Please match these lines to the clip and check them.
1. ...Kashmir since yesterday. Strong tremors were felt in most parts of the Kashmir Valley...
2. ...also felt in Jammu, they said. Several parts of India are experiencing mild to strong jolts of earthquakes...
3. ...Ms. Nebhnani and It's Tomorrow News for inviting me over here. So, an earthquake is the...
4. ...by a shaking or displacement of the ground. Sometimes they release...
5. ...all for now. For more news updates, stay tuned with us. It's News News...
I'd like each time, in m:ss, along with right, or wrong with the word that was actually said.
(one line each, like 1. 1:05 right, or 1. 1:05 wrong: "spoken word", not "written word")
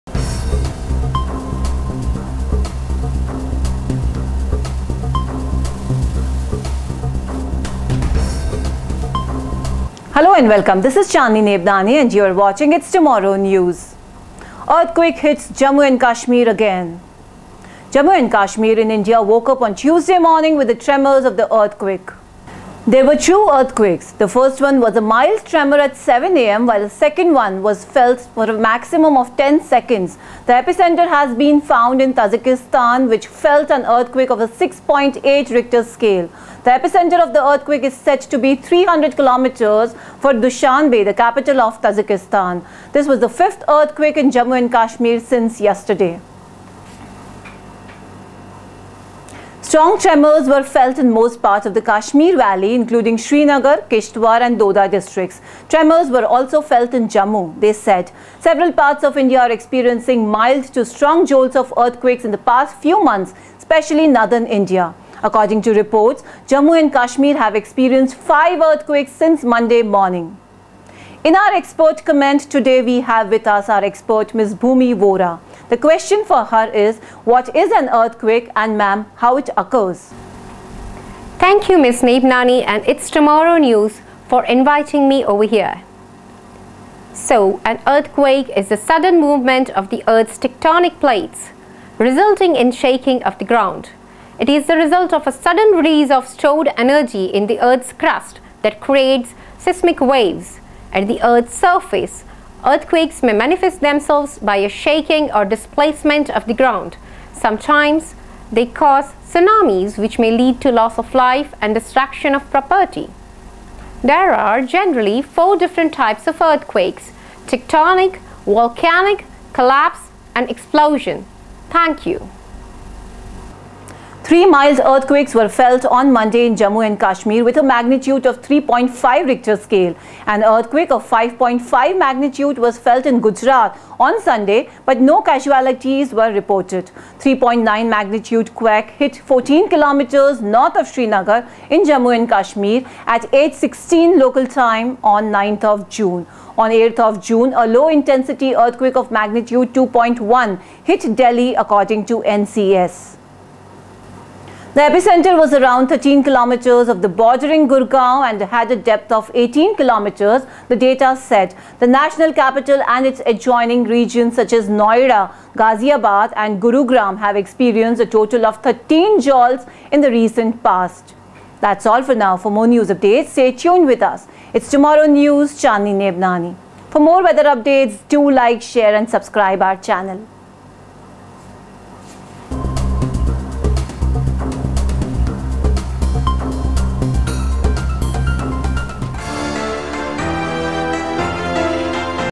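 1. 0:44 right
2. 0:56 right
3. 1:21 right
4. 1:44 wrong: "cause", not "release"
5. 2:51 wrong: "Tomorrow", not "News".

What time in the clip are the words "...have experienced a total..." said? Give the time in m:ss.
2:47.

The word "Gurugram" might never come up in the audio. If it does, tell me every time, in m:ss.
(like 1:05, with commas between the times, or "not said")
2:46.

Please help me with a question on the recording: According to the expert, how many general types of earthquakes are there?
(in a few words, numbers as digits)
4.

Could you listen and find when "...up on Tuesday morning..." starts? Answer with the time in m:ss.
0:19.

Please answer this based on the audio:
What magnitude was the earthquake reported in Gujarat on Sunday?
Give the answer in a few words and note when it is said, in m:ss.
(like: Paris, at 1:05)
5.5, at 2:11.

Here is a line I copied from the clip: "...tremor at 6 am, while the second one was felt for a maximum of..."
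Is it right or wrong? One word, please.
wrong.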